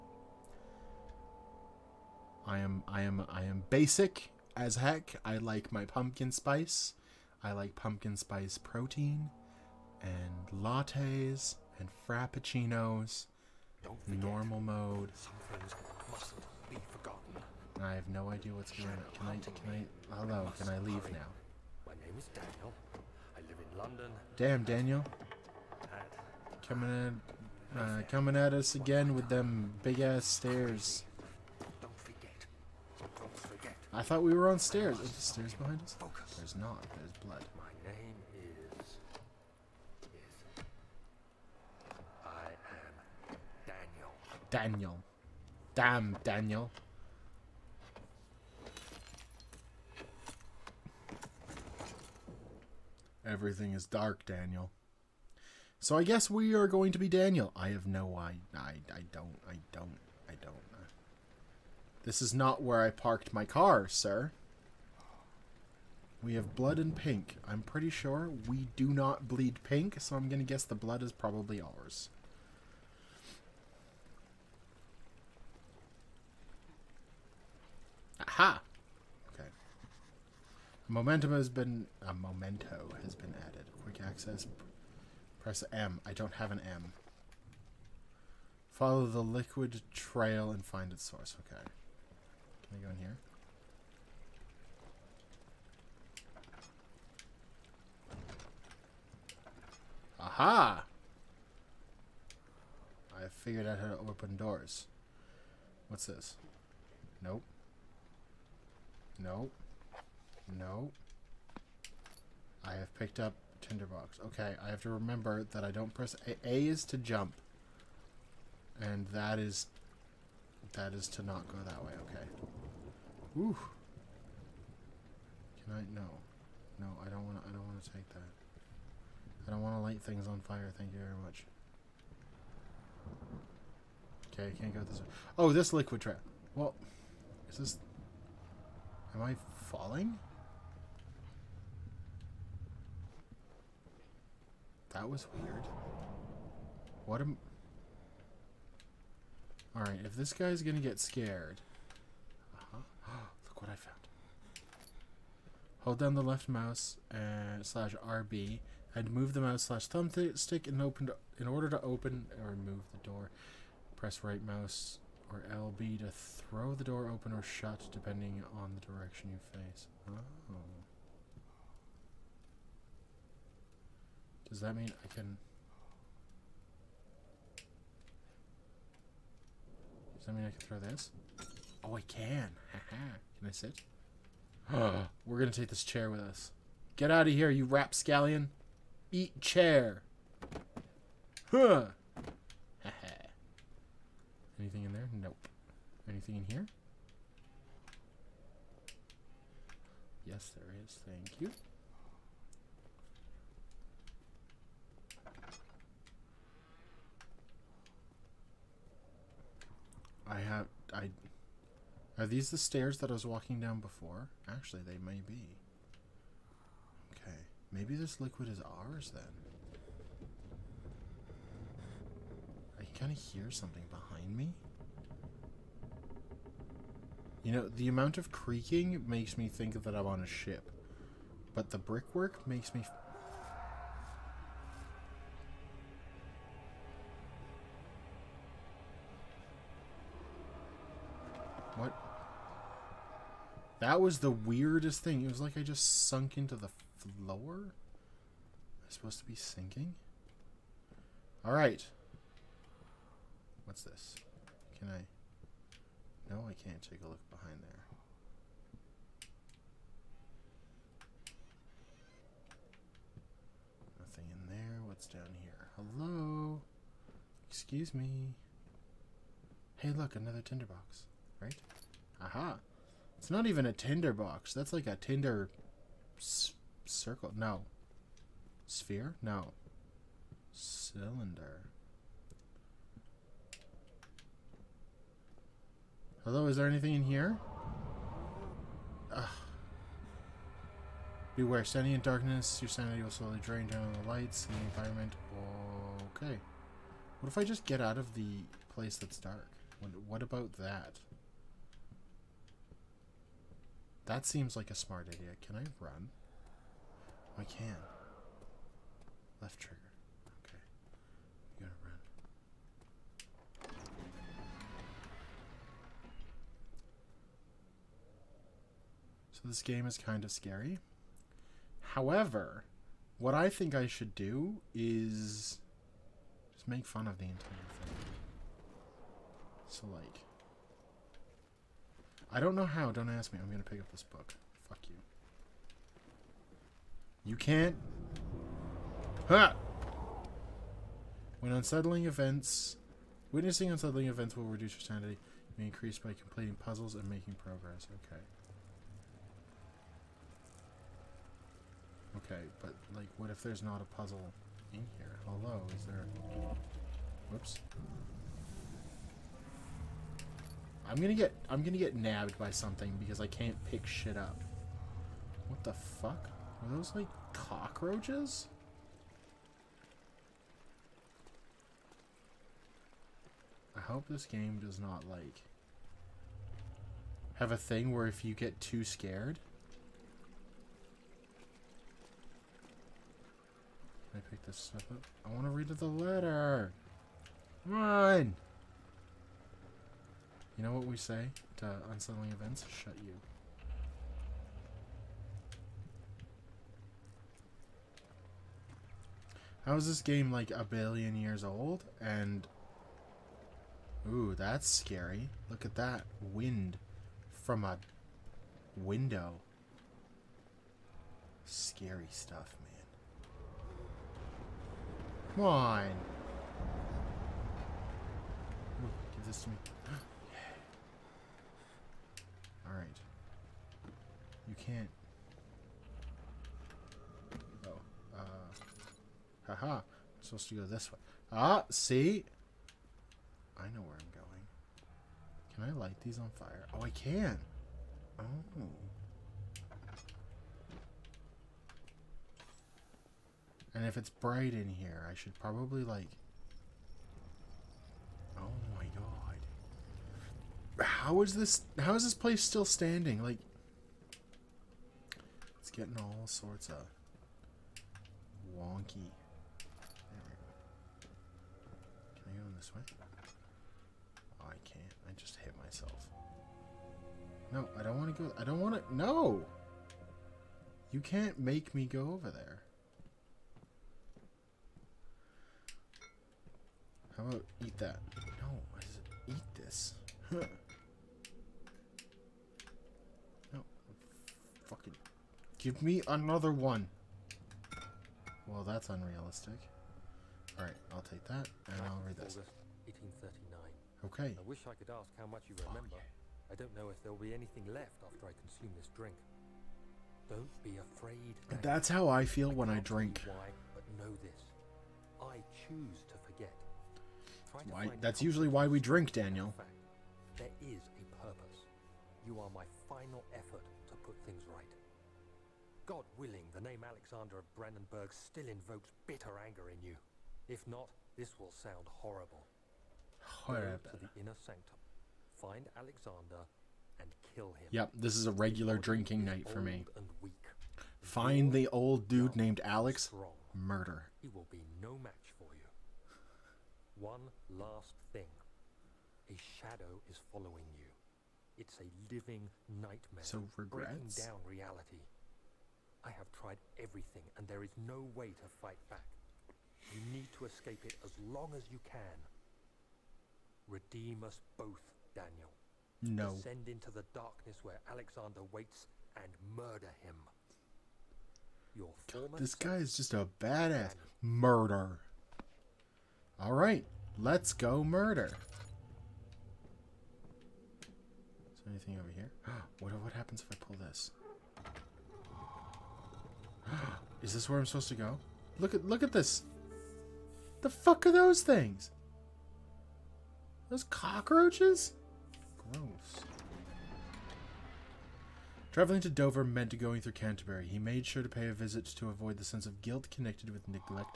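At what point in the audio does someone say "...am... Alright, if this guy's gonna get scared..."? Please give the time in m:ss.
2:27.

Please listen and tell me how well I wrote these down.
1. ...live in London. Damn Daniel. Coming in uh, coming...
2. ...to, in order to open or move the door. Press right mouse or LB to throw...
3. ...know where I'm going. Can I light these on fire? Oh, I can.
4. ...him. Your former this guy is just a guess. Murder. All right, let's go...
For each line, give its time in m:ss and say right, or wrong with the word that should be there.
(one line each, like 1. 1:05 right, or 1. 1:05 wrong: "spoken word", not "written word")
1. 0:23 right
2. 2:41 right
3. 7:13 right
4. 9:20 wrong: "badass", not "guess".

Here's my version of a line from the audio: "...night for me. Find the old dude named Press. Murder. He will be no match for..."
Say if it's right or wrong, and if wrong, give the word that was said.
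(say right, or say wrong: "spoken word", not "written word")
wrong: "Alex", not "Press".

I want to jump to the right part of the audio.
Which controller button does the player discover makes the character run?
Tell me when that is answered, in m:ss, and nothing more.
5:09.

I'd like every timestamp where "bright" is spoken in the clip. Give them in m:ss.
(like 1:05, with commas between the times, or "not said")
7:24.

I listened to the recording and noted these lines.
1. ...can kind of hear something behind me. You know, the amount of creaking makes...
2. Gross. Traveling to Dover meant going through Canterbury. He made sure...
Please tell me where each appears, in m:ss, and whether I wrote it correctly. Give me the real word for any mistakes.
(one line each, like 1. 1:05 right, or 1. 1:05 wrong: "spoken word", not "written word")
1. 3:42 right
2. 9:45 right.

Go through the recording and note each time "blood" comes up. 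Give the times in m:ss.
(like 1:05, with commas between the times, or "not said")
0:37, 1:06, 1:10.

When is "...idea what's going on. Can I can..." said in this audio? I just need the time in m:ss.
0:18.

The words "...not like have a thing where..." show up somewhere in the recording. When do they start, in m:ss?
6:14.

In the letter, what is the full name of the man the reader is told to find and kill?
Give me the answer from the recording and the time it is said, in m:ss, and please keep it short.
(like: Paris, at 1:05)
Alexander of Brandenburg, at 8:36.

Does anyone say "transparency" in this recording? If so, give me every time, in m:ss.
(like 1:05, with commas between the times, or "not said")
not said.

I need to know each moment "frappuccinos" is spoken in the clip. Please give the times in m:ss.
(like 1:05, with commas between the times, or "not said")
0:12.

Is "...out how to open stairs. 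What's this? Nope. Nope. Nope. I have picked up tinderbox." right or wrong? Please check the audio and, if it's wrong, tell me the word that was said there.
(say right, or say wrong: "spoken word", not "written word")
wrong: "doors", not "stairs".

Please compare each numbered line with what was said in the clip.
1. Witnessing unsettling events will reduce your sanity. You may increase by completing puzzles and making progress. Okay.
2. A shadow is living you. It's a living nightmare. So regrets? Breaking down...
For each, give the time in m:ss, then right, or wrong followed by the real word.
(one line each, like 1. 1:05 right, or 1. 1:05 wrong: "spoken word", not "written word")
1. 5:43 right
2. 8:59 wrong: "following", not "living".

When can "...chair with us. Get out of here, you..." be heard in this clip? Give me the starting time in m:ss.
3:05.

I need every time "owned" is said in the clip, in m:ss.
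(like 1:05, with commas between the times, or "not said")
not said.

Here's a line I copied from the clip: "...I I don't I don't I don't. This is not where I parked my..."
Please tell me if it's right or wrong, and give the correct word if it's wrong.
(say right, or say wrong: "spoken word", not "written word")
right.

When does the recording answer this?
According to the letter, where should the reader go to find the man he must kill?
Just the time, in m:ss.
8:44.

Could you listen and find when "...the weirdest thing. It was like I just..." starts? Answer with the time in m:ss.
4:04.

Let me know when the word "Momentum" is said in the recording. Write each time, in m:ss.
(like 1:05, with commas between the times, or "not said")
1:20.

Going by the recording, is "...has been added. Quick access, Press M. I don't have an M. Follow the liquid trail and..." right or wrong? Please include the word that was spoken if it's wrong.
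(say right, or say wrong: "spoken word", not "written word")
right.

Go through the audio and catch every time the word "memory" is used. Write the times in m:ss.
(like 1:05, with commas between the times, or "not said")
not said.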